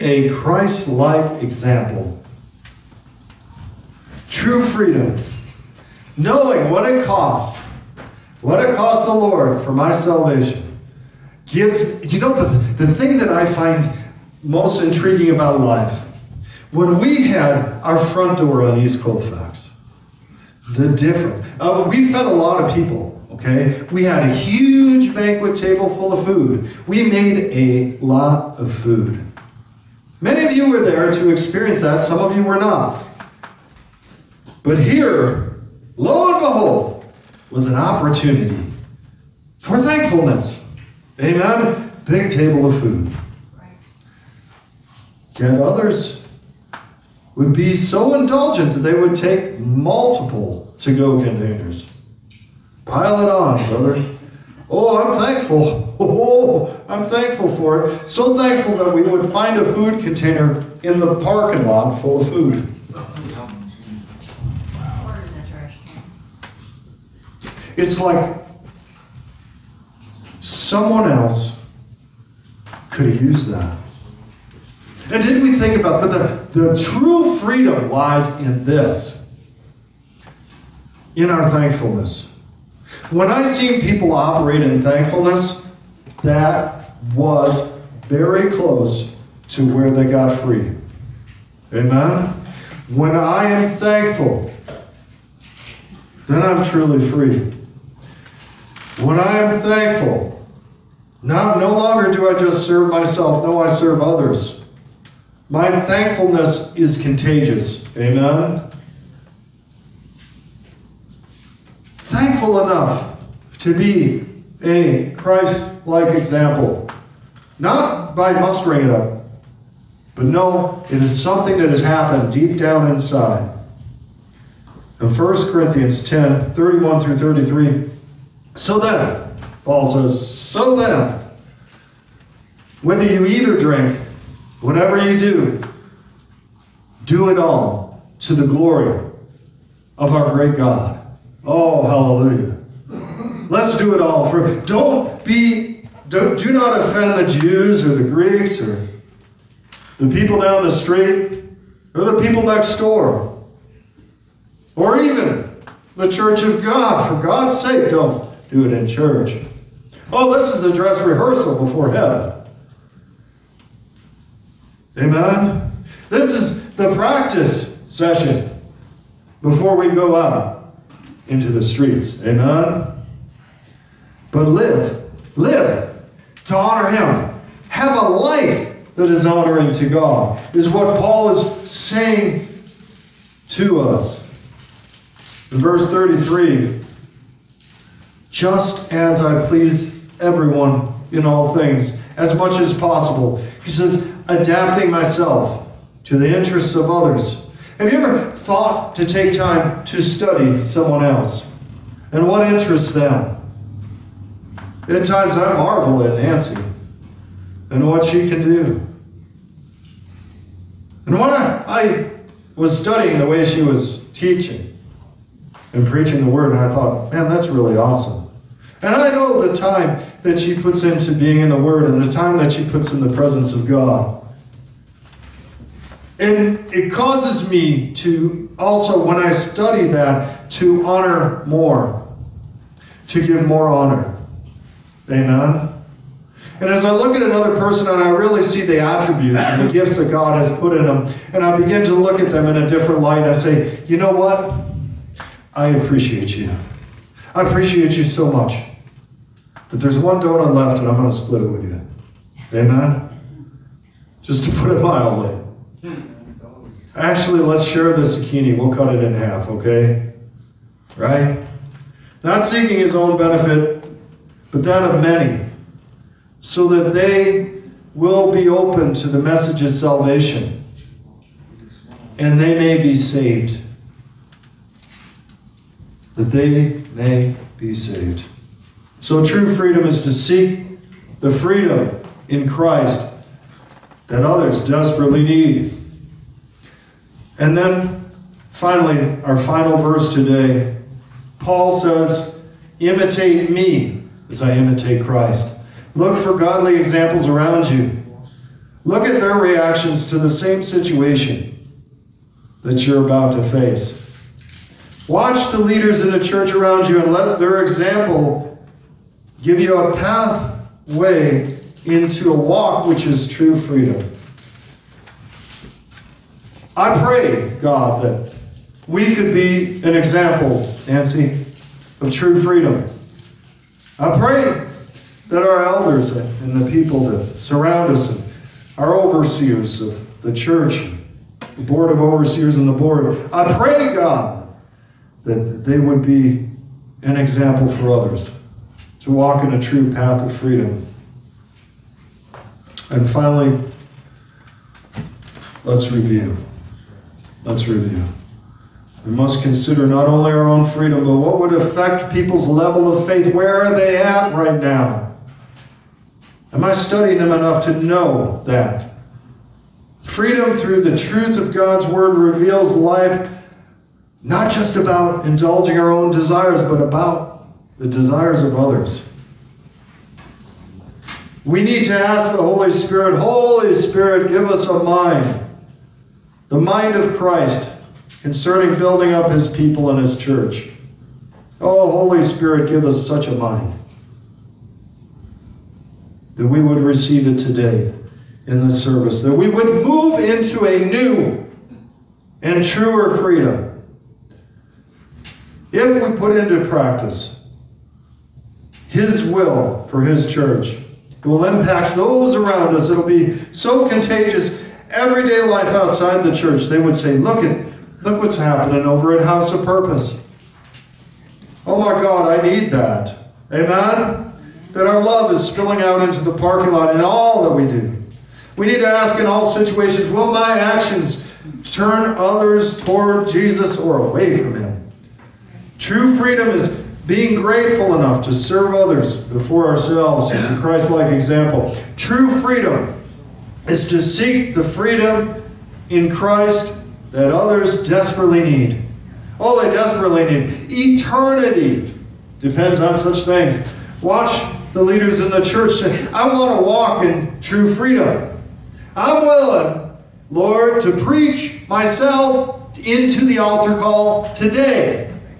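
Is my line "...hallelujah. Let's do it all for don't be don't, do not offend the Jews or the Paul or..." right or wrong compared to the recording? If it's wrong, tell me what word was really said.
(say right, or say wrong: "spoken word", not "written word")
wrong: "Greeks", not "Paul".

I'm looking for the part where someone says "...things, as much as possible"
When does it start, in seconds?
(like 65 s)
191 s.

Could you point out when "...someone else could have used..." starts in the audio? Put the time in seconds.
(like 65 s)
70 s.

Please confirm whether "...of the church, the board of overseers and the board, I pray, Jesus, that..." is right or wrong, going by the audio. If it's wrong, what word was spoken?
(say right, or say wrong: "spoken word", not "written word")
wrong: "God", not "Jesus".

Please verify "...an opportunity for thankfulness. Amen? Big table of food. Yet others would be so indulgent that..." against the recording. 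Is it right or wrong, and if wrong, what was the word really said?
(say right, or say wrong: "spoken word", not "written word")
right.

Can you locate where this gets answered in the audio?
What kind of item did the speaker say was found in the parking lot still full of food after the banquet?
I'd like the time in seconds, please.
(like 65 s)
59 s.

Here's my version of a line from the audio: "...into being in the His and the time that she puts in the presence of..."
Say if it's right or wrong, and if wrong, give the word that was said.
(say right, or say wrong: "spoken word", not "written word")
wrong: "Word", not "His".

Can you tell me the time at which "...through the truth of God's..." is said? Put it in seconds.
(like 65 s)
360 s.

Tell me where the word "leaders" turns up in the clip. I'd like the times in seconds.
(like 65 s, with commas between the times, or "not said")
305 s, 444 s.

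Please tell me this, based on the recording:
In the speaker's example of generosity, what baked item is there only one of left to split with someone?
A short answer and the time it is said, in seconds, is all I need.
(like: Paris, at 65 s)
Donut, at 250 s.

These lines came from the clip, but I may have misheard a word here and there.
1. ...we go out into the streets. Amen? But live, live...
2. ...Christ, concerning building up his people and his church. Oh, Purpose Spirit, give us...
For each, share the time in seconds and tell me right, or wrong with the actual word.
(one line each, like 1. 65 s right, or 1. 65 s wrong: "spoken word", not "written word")
1. 169 s right
2. 377 s wrong: "Holy", not "Purpose".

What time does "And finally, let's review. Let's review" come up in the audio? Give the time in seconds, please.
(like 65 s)
342 s.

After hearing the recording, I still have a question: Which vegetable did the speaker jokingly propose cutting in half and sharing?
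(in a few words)
Zucchini.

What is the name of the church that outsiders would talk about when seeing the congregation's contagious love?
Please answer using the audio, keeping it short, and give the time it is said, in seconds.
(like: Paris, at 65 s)
House of Purpose, at 409 s.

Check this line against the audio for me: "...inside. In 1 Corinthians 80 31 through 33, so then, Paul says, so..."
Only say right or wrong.
wrong.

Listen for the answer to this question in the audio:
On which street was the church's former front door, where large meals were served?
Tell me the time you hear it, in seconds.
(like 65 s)
18 s.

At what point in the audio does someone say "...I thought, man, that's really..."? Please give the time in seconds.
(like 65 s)
216 s.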